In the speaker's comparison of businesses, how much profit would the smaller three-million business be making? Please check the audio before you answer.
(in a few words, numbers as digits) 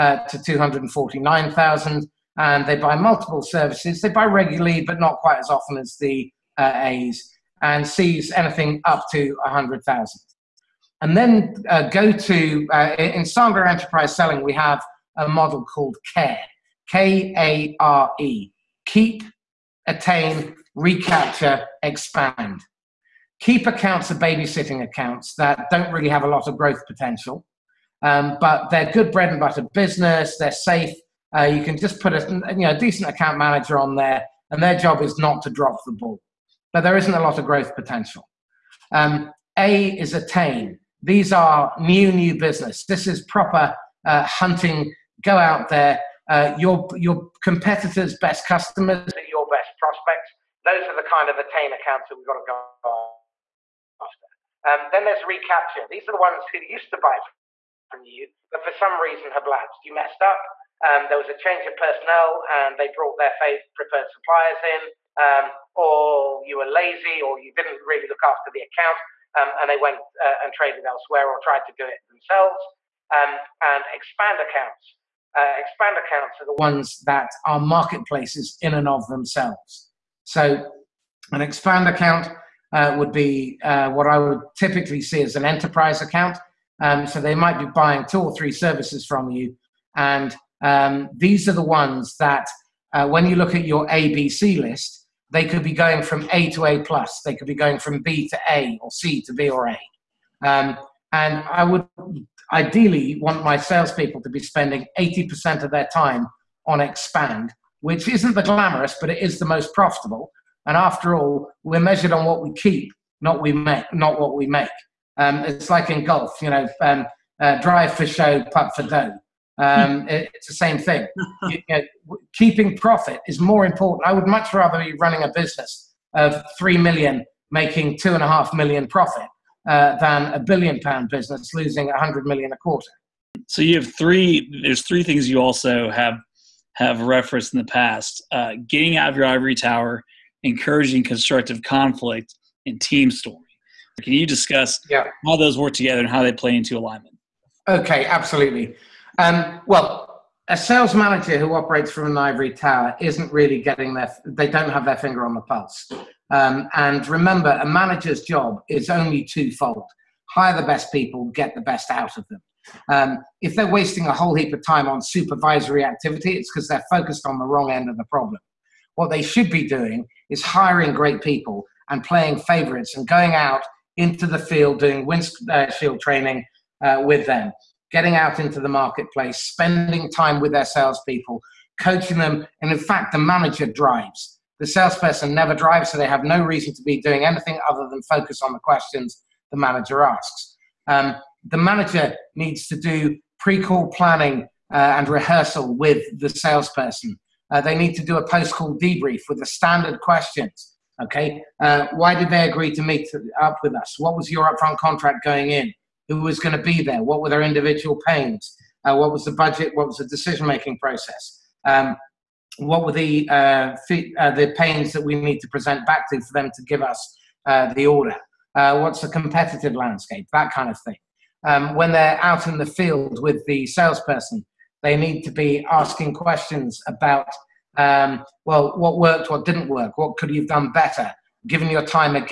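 2.5 million.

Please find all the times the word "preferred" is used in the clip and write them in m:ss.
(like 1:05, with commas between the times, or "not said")
1:03.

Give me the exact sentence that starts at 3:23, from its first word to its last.
What was your upfront contract going in?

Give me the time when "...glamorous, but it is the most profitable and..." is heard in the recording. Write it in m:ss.
1:48.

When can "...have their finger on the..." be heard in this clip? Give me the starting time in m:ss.
2:34.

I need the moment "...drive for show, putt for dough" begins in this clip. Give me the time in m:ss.
1:57.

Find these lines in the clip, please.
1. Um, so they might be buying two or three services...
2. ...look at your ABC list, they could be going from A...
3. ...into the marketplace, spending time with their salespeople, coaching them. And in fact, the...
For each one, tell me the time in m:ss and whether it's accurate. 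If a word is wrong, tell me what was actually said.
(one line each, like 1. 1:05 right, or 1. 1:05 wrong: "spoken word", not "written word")
1. 1:26 right
2. 1:33 right
3. 2:58 right.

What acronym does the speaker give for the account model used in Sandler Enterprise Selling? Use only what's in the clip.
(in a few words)
KARE.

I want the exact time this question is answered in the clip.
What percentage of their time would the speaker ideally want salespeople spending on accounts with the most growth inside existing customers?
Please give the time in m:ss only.
1:44.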